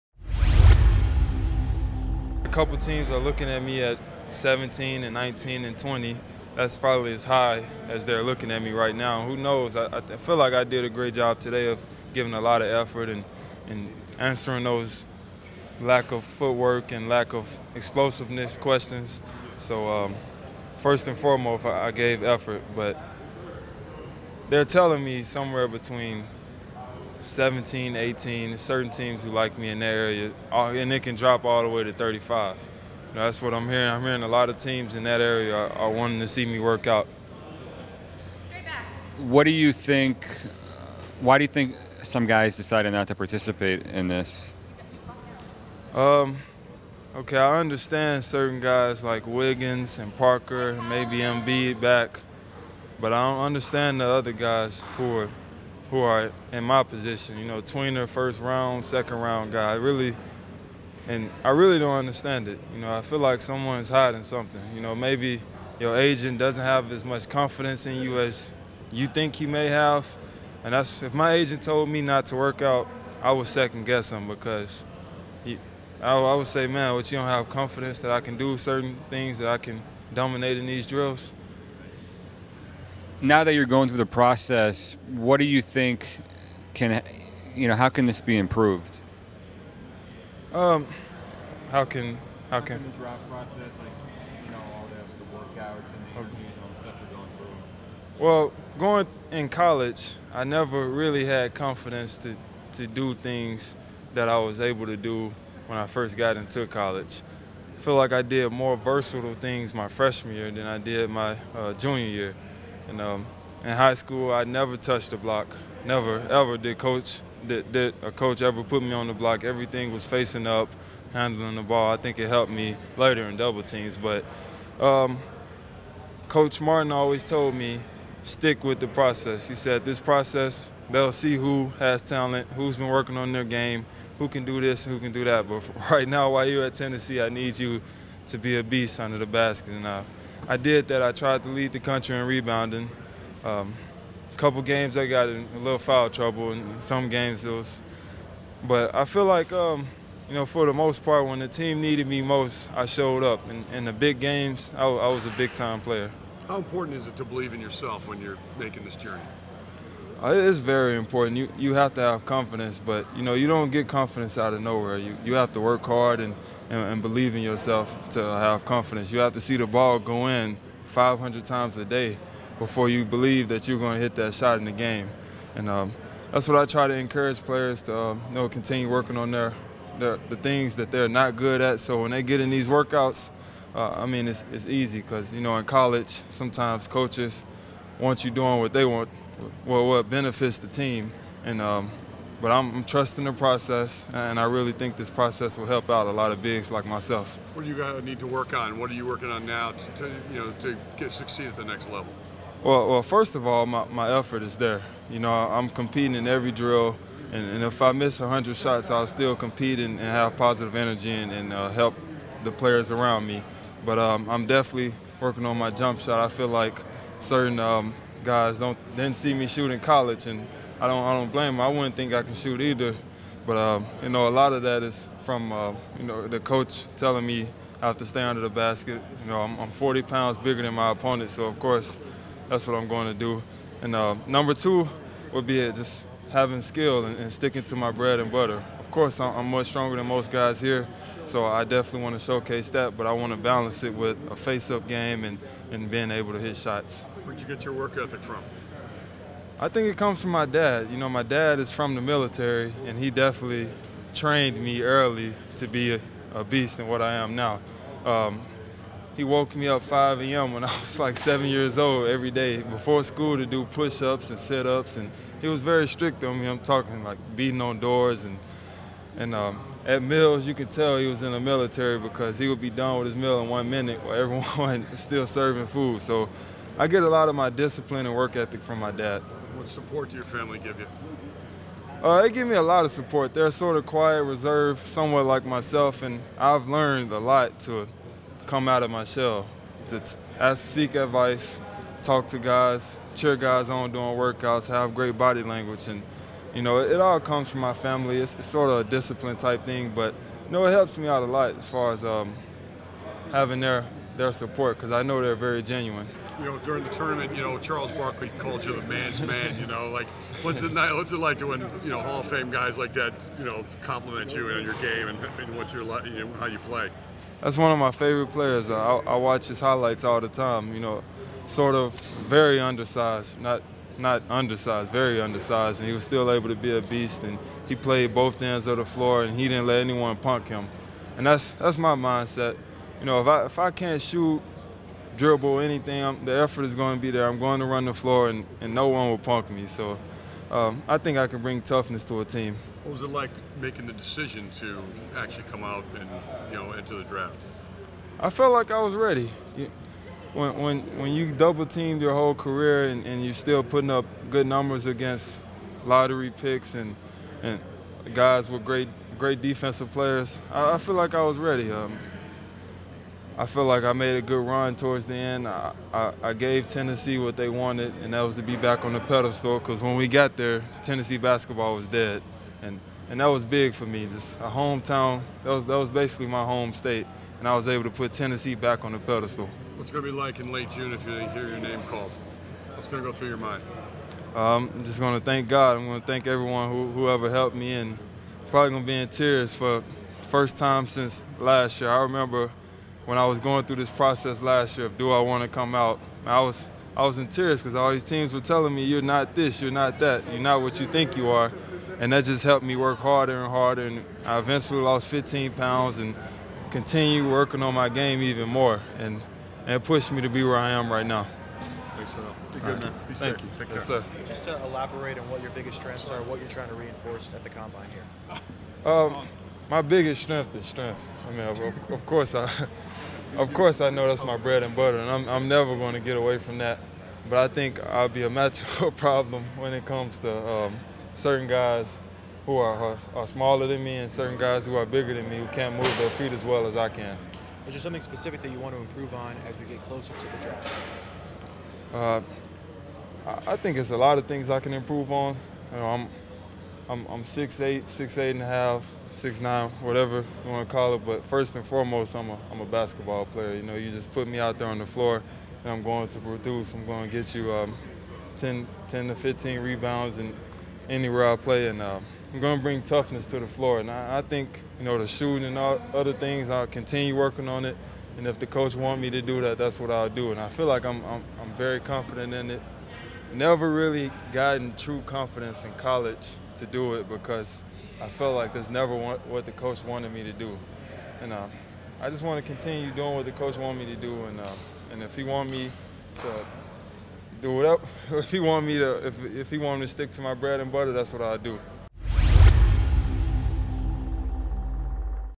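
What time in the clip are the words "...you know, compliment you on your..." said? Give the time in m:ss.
5:13.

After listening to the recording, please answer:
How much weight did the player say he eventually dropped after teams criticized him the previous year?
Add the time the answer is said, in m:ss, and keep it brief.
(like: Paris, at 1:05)
15 pounds, at 6:45.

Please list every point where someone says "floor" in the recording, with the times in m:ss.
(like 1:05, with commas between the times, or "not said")
5:28, 5:37, 7:34, 7:43.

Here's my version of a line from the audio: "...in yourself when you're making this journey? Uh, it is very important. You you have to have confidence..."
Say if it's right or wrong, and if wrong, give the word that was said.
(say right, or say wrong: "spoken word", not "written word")
right.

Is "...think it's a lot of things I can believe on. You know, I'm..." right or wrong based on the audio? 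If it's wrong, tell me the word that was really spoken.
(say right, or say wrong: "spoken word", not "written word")
wrong: "improve", not "believe".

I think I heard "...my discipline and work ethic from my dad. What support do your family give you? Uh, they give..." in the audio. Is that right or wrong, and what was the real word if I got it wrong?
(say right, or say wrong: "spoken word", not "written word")
right.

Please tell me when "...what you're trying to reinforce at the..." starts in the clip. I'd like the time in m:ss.
6:56.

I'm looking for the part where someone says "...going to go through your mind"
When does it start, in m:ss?
6:22.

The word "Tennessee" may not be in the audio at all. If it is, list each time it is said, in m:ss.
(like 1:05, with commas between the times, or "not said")
2:16, 6:06, 6:10, 6:18.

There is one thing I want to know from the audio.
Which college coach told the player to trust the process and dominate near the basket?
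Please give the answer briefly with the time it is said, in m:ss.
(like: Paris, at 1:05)
Coach Martin, at 2:06.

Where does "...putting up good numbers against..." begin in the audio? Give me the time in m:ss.
5:53.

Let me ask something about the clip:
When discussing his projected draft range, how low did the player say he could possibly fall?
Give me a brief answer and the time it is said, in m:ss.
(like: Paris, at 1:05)
35, at 0:31.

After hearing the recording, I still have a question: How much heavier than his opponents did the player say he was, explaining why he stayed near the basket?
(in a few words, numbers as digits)
40 pounds.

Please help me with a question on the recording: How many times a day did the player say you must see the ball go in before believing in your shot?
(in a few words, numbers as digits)
500.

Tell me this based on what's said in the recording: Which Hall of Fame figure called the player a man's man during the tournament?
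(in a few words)
Charles Barkley.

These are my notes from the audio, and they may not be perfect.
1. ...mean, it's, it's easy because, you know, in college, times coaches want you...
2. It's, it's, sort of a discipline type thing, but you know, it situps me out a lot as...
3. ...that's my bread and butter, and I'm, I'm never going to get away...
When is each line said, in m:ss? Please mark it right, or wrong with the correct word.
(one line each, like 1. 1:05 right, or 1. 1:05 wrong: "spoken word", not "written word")
1. 3:04 wrong: "sometimes", not "times"
2. 4:58 wrong: "helps", not "situps"
3. 7:04 right.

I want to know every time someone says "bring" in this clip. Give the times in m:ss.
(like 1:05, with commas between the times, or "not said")
5:41, 7:42.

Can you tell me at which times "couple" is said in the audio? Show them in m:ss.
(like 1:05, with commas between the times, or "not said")
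0:02, 2:24.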